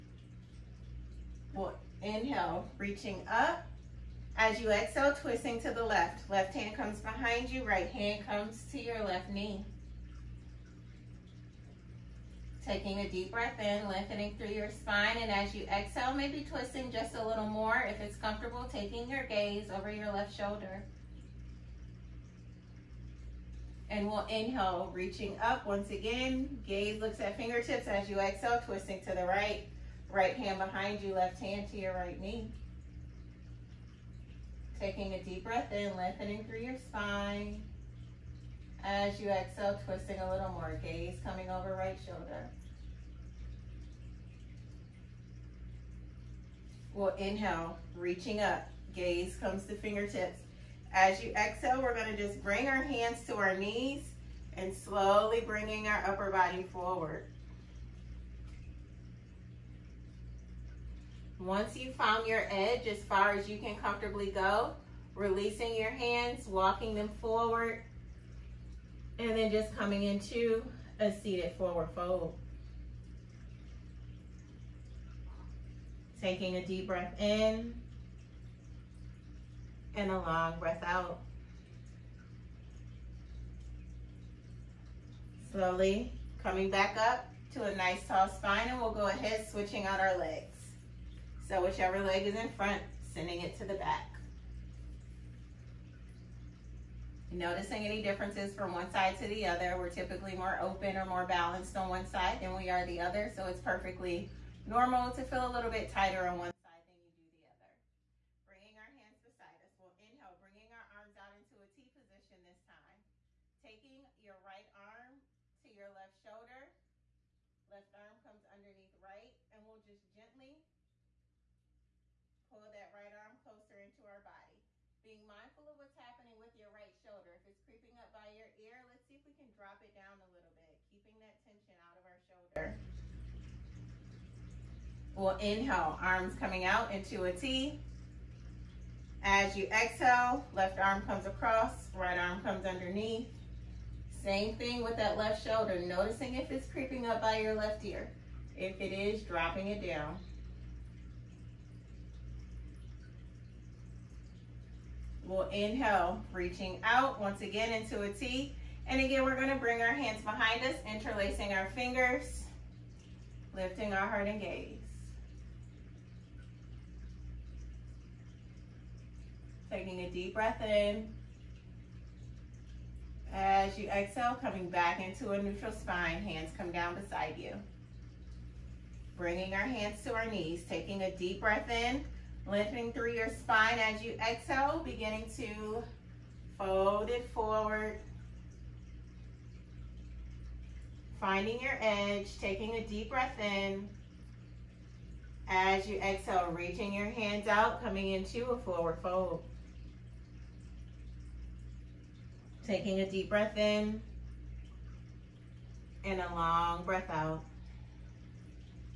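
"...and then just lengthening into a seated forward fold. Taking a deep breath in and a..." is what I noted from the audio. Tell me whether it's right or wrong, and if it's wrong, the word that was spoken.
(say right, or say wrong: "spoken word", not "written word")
wrong: "coming", not "lengthening".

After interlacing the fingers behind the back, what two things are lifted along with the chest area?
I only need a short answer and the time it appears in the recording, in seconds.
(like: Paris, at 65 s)
Heart and gaze, at 164 s.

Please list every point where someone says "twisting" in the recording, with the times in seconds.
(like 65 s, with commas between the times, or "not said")
5 s, 16 s, 28 s, 39 s.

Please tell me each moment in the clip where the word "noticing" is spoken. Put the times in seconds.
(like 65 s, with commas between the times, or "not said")
97 s, 145 s.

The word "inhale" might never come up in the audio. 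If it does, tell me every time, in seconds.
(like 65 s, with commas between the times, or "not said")
2 s, 24 s, 47 s, 109 s, 135 s, 155 s.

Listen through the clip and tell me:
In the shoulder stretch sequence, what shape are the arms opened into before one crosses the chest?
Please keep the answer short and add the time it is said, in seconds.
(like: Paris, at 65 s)
T position, at 111 s.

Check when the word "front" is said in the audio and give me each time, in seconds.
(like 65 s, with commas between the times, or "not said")
92 s.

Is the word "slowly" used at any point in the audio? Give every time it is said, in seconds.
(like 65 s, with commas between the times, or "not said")
54 s, 85 s.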